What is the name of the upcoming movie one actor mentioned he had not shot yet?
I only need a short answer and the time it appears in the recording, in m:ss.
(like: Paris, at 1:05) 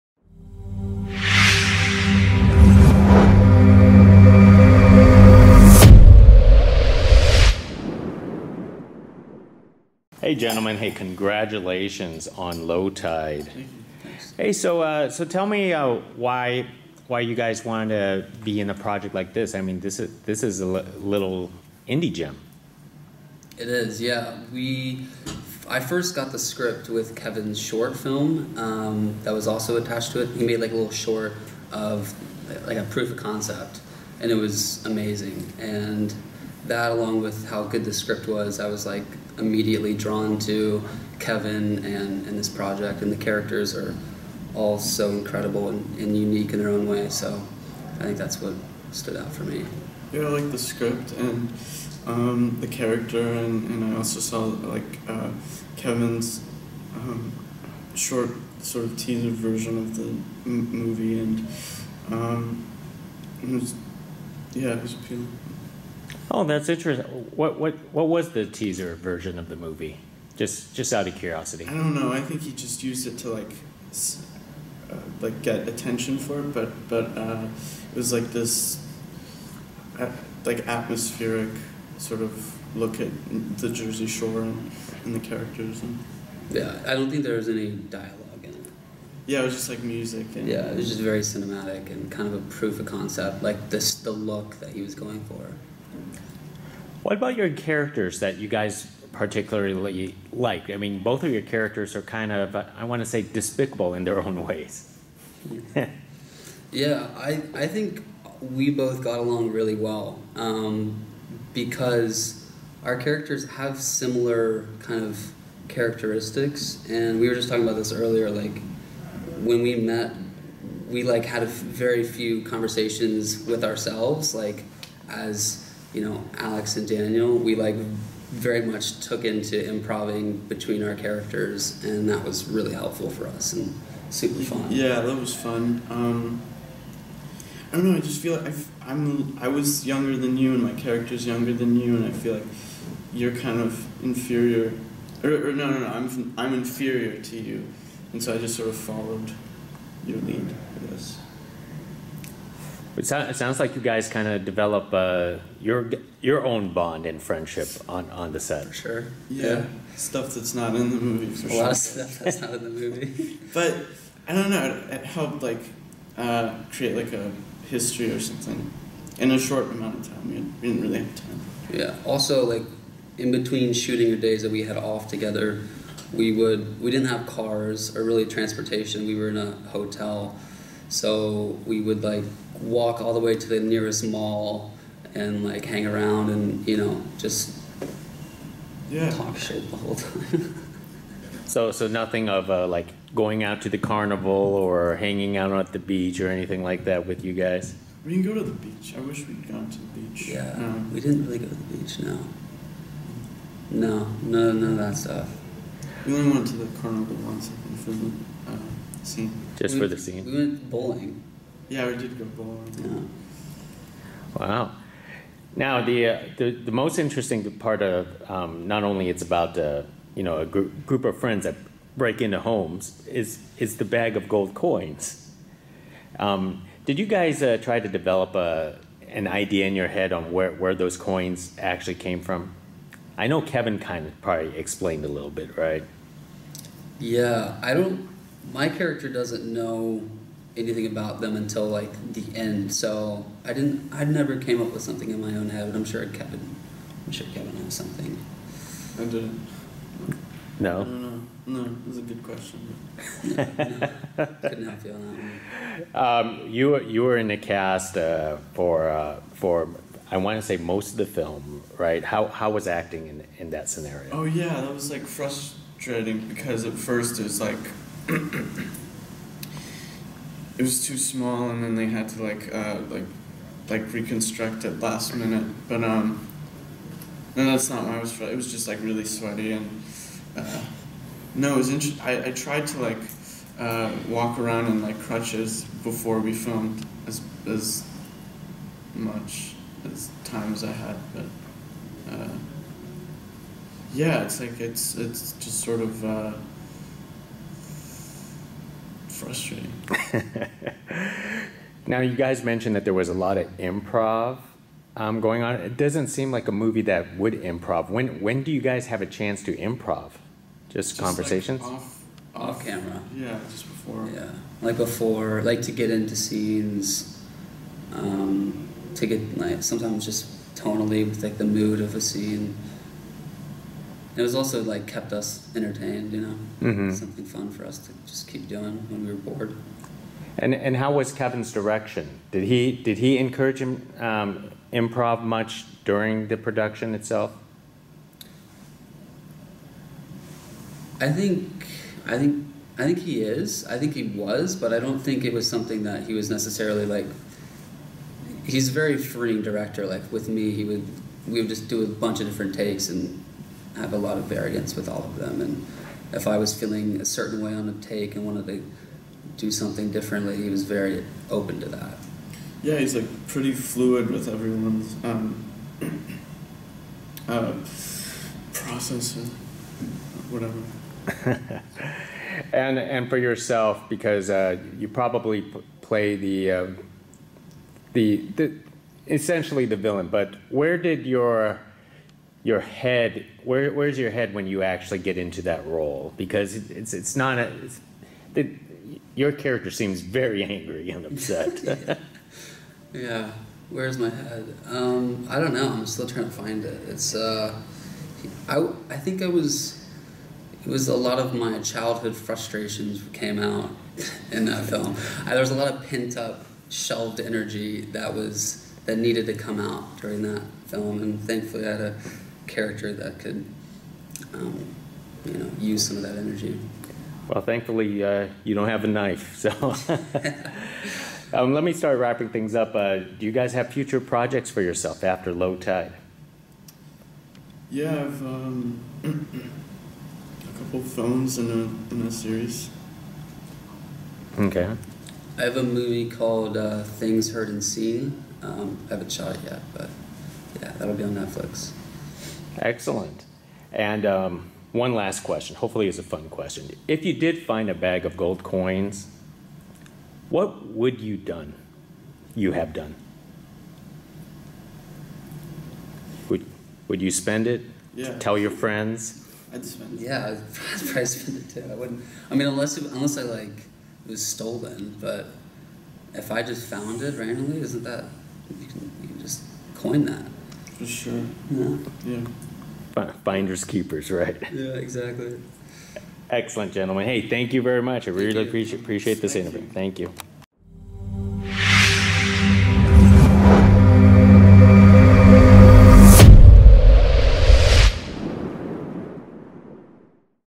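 Things Heard and Seen, at 7:16.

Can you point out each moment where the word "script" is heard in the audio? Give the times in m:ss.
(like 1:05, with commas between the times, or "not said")
0:26, 0:37, 0:50.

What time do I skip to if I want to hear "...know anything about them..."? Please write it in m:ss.
3:59.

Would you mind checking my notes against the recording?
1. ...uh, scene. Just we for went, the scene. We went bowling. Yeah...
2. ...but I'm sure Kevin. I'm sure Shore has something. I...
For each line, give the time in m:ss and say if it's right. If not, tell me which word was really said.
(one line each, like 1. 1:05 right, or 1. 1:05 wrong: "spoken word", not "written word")
1. 3:28 right
2. 4:05 wrong: "Kevin", not "Shore".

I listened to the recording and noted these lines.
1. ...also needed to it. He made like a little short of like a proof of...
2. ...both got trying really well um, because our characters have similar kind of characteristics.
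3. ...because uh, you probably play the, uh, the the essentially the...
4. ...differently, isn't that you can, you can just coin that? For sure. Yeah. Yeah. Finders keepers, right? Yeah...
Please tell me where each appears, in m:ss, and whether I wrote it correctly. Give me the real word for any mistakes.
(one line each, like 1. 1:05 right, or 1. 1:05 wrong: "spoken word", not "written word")
1. 0:29 wrong: "attached", not "needed"
2. 1:48 wrong: "along", not "trying"
3. 6:13 right
4. 7:47 wrong: "randomly", not "differently".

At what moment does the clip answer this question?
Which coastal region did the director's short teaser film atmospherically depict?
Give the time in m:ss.
1:23.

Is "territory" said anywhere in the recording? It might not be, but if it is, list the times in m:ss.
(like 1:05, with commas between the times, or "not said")
not said.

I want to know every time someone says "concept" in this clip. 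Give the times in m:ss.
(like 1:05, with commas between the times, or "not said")
0:33, 1:32.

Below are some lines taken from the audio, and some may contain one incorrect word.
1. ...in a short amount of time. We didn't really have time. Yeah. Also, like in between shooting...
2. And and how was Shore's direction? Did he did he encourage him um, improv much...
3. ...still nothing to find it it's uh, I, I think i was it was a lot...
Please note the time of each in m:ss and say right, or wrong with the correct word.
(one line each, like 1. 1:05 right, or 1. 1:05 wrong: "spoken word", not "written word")
1. 2:49 right
2. 5:30 wrong: "Kevin", not "Shore"
3. 6:35 wrong: "trying", not "nothing".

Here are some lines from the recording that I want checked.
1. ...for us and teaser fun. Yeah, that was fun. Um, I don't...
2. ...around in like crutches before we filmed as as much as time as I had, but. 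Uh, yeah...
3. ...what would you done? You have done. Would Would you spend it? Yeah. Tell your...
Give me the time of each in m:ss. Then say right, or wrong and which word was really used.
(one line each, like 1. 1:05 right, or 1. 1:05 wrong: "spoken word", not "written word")
1. 2:13 wrong: "super", not "teaser"
2. 4:44 right
3. 7:30 right.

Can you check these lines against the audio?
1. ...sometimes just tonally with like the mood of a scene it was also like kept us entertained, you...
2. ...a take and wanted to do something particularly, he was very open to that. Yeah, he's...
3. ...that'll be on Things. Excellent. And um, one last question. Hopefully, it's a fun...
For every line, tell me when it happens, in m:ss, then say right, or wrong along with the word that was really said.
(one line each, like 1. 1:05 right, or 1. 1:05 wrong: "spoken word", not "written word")
1. 5:19 right
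2. 5:57 wrong: "differently", not "particularly"
3. 7:20 wrong: "Netflix", not "Things".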